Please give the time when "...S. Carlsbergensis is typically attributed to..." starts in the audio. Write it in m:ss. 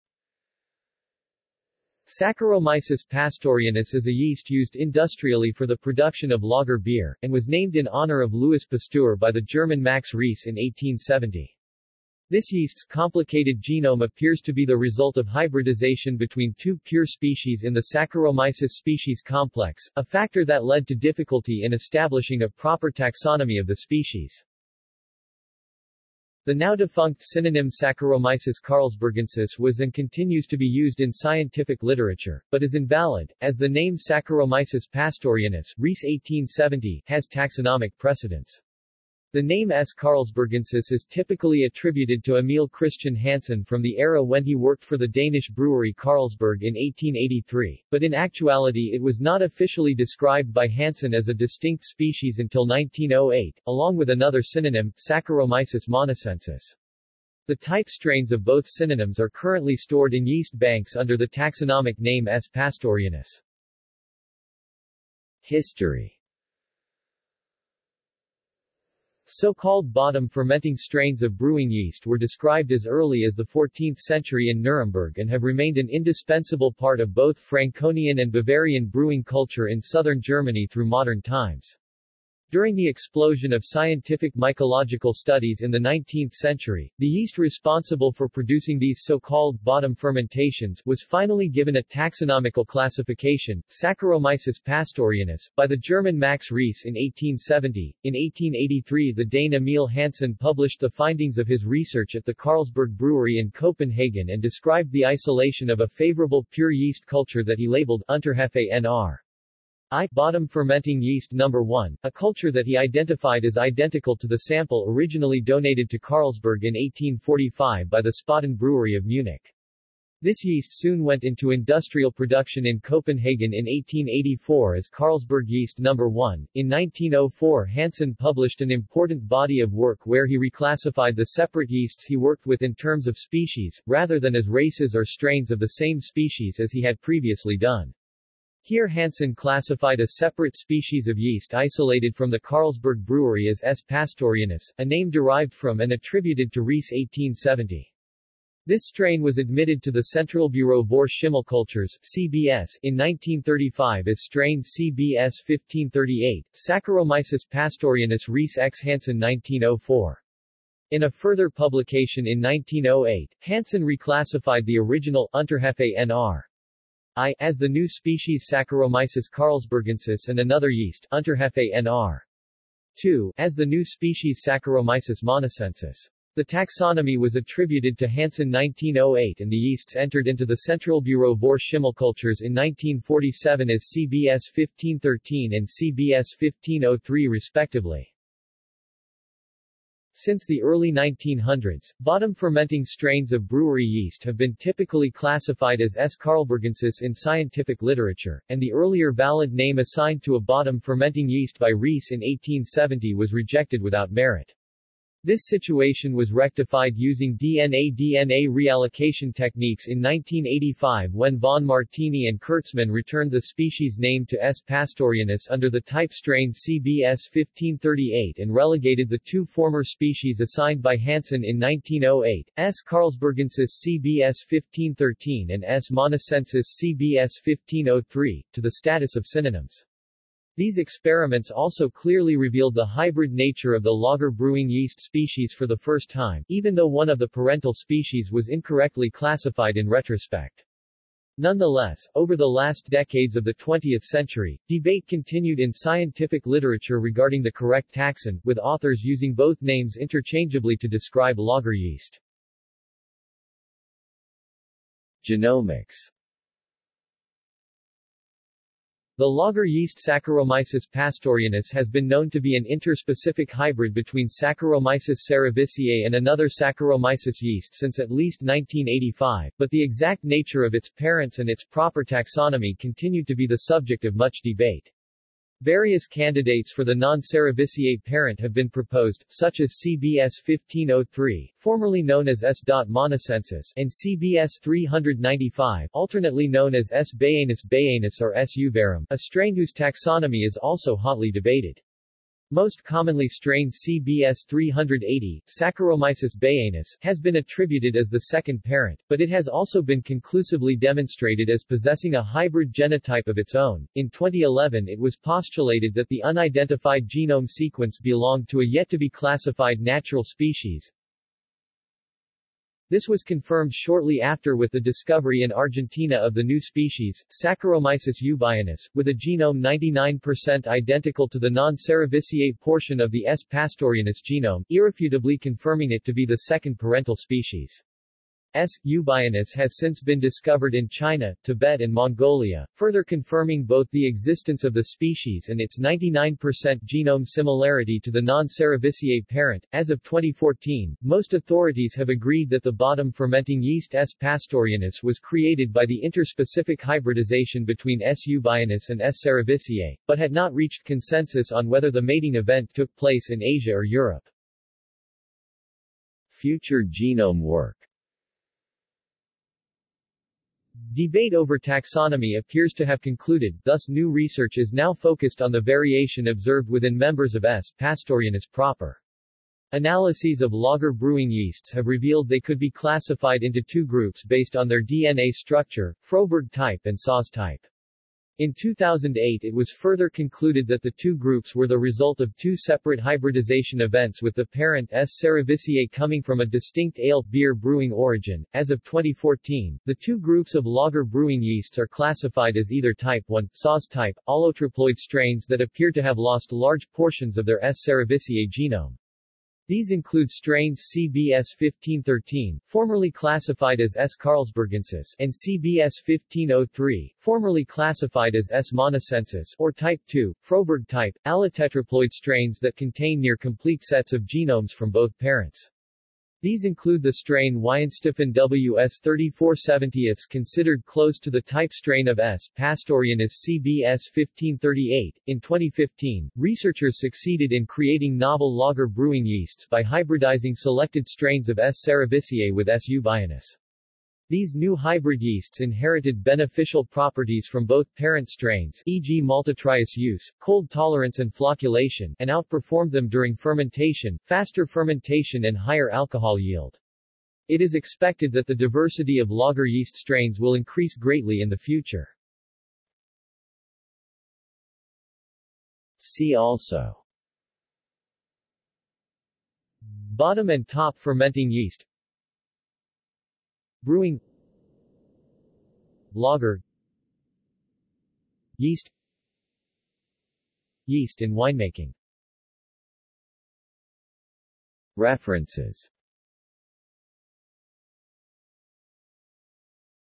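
0:39.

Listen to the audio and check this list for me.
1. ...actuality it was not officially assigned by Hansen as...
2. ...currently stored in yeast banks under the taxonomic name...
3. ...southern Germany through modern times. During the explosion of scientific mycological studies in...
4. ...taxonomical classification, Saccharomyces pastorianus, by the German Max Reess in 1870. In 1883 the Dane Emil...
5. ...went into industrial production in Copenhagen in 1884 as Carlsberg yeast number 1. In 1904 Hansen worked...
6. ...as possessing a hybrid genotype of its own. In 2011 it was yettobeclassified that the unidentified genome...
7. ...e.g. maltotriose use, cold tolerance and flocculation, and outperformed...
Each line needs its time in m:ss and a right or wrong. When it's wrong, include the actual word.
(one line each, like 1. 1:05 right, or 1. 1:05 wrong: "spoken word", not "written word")
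1. 0:48 wrong: "described", not "assigned"
2. 0:59 right
3. 1:19 right
4. 1:31 right
5. 2:01 wrong: "published", not "worked"
6. 5:01 wrong: "postulated", not "yettobeclassified"
7. 7:18 right.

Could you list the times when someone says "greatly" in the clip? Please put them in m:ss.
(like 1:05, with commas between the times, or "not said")
7:30.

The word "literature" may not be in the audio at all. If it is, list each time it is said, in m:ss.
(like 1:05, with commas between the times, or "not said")
0:31, 3:17, 4:06.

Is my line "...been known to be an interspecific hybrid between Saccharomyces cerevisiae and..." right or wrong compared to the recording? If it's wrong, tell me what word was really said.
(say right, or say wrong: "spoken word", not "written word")
right.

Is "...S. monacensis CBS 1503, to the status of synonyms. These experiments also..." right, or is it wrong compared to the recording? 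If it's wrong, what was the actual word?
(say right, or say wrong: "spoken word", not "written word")
right.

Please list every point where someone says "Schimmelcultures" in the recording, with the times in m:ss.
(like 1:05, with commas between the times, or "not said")
2:31, 3:01.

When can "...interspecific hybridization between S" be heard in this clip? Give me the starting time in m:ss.
5:46.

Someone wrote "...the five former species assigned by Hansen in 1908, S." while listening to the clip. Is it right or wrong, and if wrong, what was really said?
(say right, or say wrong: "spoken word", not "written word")
wrong: "two", not "five".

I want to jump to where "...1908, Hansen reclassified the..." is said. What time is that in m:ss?
2:42.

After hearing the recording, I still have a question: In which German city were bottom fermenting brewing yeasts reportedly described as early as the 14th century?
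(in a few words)
Nuremberg.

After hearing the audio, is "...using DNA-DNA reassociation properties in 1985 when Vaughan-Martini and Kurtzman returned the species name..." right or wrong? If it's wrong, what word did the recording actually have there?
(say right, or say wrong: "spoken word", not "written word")
wrong: "techniques", not "properties".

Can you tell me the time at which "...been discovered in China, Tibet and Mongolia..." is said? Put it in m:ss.
5:30.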